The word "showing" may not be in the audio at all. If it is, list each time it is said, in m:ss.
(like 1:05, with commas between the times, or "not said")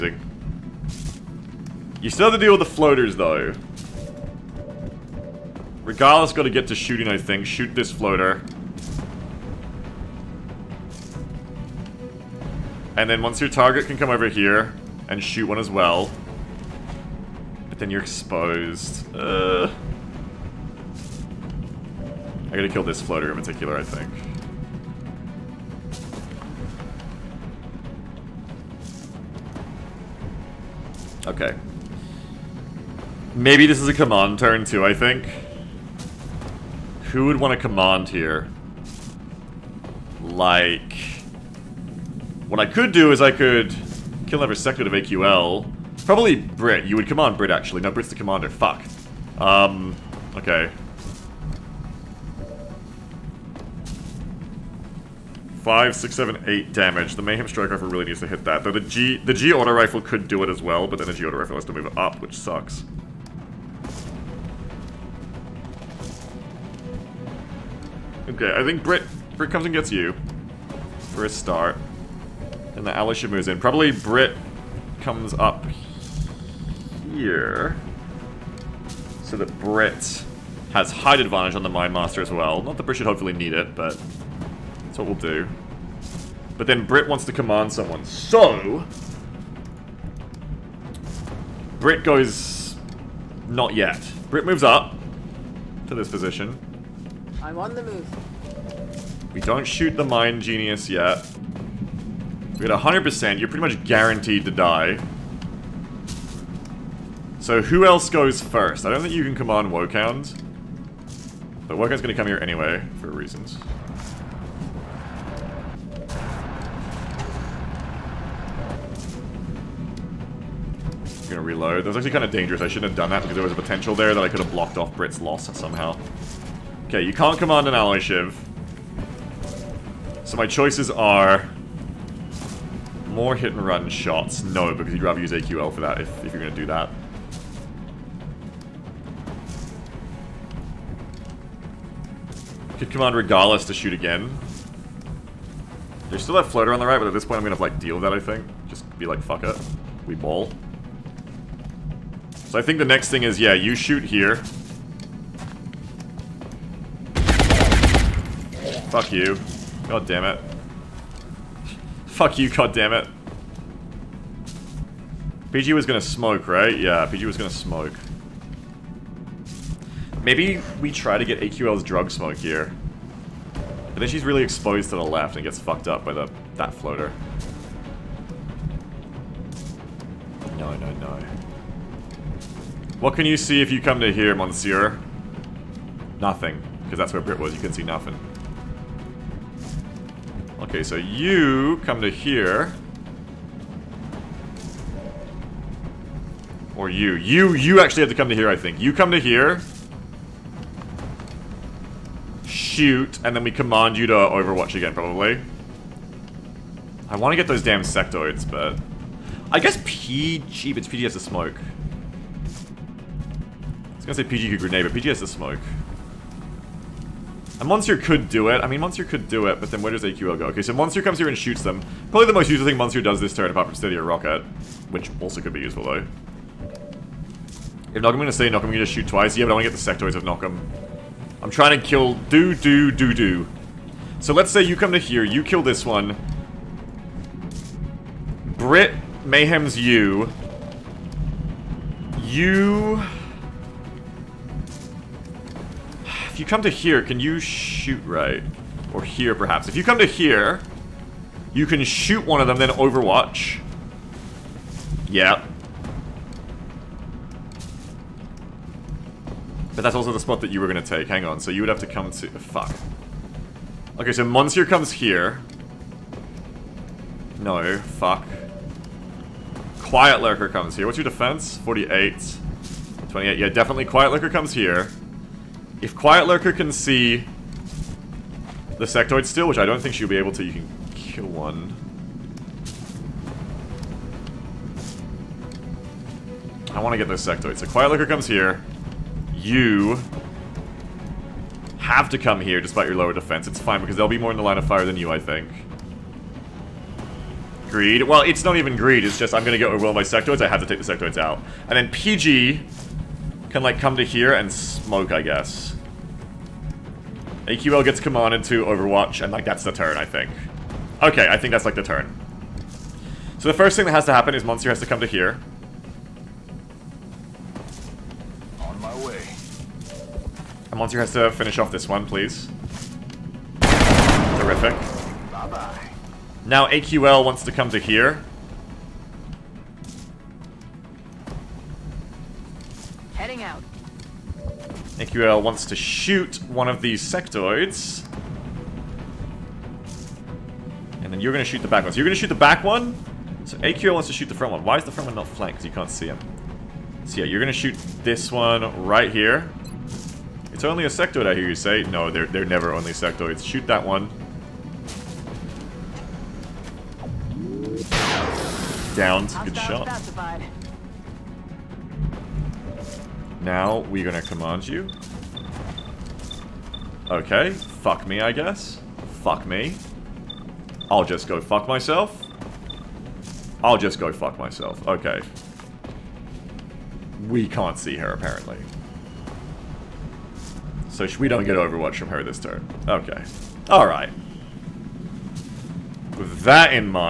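not said.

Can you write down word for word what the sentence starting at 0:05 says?
Regardless, gotta get to shooting, I think.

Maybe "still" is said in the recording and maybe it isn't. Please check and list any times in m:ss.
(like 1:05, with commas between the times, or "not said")
0:02, 2:26, 4:39.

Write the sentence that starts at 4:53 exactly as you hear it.
It's fine because they'll be more in the line of fire than you, I think.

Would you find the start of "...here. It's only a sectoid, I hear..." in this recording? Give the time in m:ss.
5:49.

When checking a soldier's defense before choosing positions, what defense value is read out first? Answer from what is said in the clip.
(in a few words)
48.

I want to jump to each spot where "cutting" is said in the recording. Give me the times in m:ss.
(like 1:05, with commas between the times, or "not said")
not said.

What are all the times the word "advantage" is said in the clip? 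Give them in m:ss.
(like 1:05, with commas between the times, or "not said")
1:21.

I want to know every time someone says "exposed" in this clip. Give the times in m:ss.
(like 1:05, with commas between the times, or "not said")
0:18, 2:54.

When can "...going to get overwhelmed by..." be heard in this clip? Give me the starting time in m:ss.
4:59.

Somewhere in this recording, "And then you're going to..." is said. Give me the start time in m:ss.
5:41.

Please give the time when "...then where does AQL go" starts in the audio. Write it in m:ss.
3:39.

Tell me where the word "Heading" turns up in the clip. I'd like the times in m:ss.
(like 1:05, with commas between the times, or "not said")
5:33.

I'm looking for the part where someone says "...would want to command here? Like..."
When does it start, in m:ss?
0:37.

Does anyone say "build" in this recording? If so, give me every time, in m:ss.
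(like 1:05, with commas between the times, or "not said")
not said.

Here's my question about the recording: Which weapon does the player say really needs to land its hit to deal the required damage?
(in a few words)
Mayhem Strike Rifle.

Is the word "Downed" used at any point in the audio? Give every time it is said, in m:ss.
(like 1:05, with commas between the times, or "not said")
5:58.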